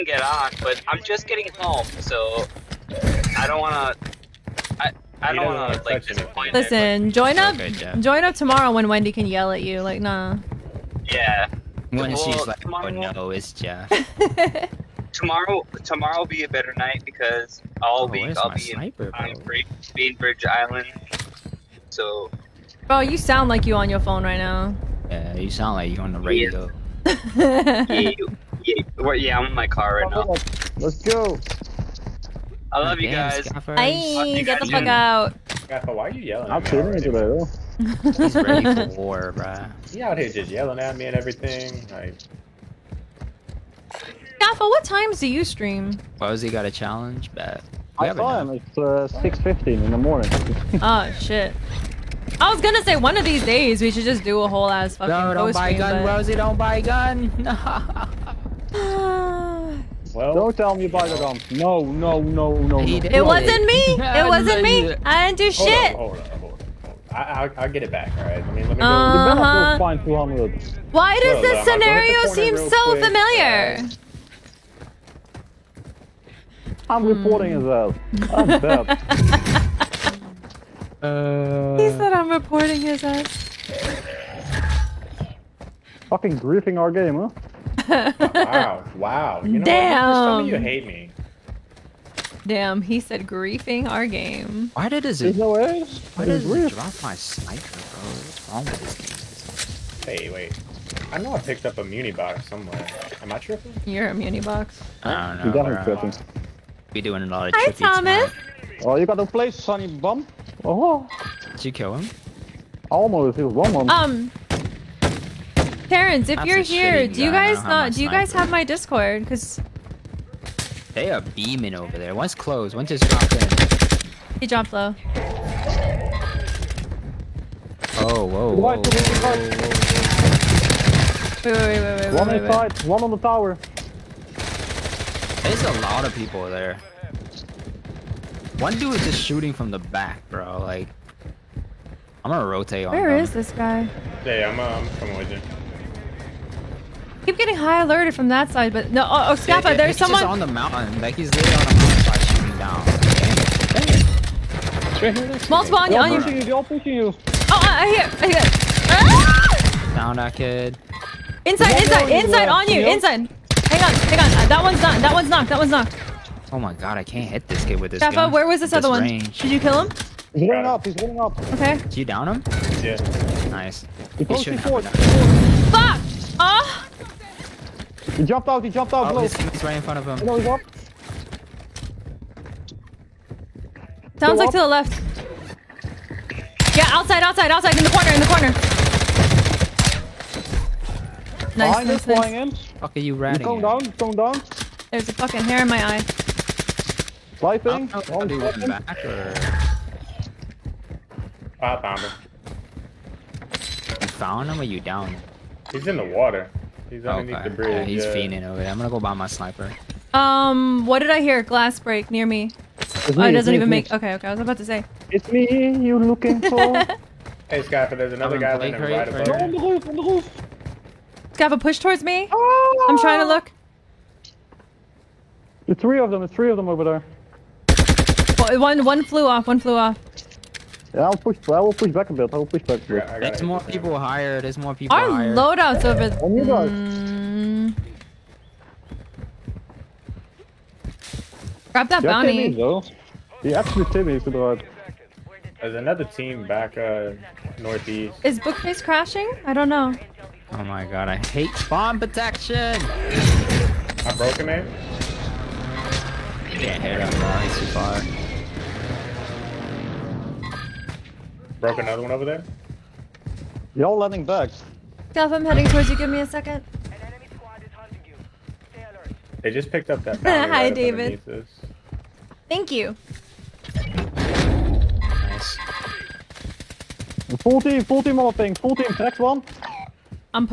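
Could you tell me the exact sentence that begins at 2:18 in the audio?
One dude is just shooting from the back, bro.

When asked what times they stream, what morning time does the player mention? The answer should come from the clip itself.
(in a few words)
6:15.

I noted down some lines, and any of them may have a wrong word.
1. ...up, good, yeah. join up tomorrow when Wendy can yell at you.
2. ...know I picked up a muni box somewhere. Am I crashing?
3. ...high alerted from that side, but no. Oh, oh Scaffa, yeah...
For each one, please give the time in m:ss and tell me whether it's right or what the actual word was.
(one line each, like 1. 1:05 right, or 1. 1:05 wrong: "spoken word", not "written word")
1. 0:07 right
2. 1:41 wrong: "tripping", not "crashing"
3. 2:27 right.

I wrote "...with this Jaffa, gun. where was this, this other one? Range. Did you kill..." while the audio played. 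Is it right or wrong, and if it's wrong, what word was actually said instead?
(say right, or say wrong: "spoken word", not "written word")
right.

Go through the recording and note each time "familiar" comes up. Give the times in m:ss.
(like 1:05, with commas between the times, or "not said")
1:13.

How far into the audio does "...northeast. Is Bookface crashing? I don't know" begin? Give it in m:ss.
4:07.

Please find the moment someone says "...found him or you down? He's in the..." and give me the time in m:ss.
3:24.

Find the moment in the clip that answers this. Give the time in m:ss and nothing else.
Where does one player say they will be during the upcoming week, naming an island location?
0:19.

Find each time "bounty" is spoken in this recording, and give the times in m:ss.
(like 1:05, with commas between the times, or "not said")
4:02.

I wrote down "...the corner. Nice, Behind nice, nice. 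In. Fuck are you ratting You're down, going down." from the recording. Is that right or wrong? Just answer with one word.
right.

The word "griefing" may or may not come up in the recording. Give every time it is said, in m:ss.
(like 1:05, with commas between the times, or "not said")
1:26, 1:33.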